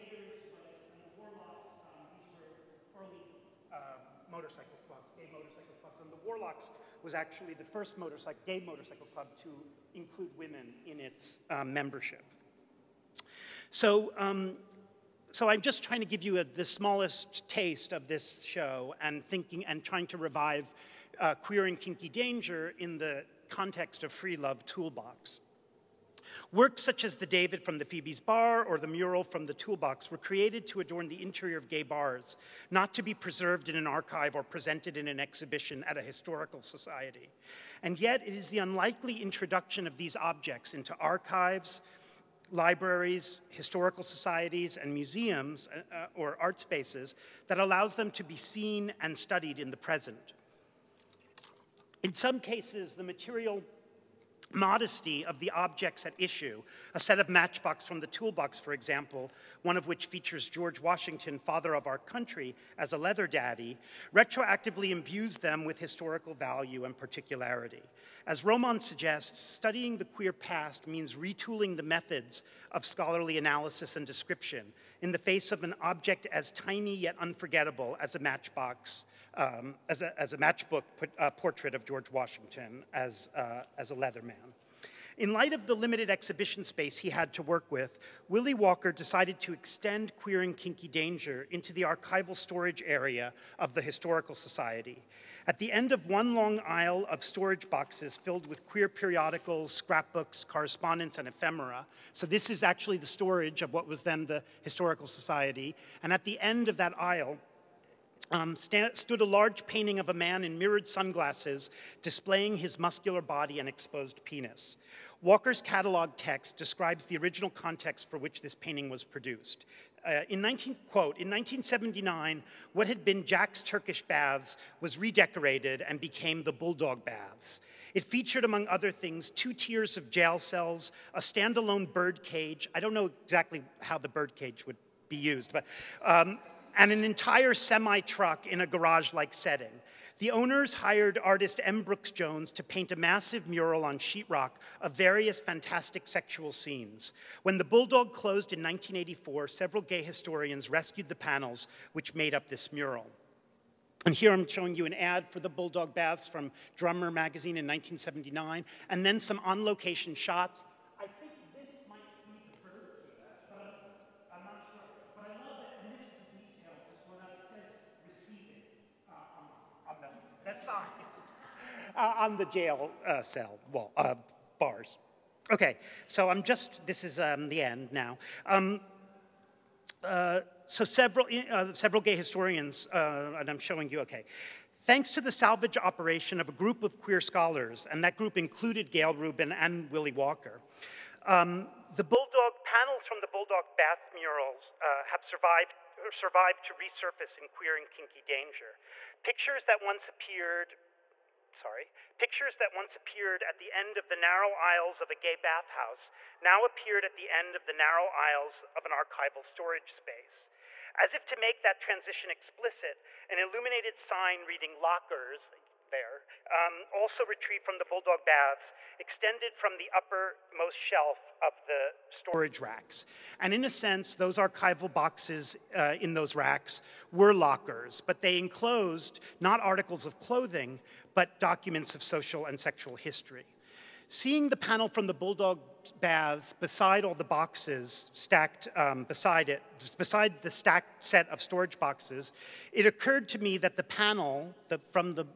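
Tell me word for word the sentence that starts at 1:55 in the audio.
Walker's catalog text describes the original context for which this painting was produced.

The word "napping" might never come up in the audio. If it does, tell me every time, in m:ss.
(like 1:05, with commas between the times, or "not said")
not said.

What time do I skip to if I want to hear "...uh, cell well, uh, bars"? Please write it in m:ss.
2:53.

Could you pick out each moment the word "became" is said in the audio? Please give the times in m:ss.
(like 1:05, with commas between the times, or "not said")
2:05.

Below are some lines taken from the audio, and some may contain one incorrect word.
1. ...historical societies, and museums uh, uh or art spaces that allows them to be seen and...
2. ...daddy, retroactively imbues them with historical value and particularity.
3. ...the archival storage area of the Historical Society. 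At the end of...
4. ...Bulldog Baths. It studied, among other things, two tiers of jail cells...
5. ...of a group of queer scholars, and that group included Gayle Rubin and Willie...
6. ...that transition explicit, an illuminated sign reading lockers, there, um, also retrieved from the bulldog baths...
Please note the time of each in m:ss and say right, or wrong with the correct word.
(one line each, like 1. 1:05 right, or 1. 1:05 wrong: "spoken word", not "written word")
1. 0:43 right
2. 1:03 right
3. 1:31 right
4. 2:06 wrong: "featured", not "studied"
5. 3:06 right
6. 3:31 right.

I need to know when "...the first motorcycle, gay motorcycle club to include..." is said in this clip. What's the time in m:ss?
0:07.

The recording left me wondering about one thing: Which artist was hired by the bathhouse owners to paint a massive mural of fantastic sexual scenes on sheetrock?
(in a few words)
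M. Brooks Jones.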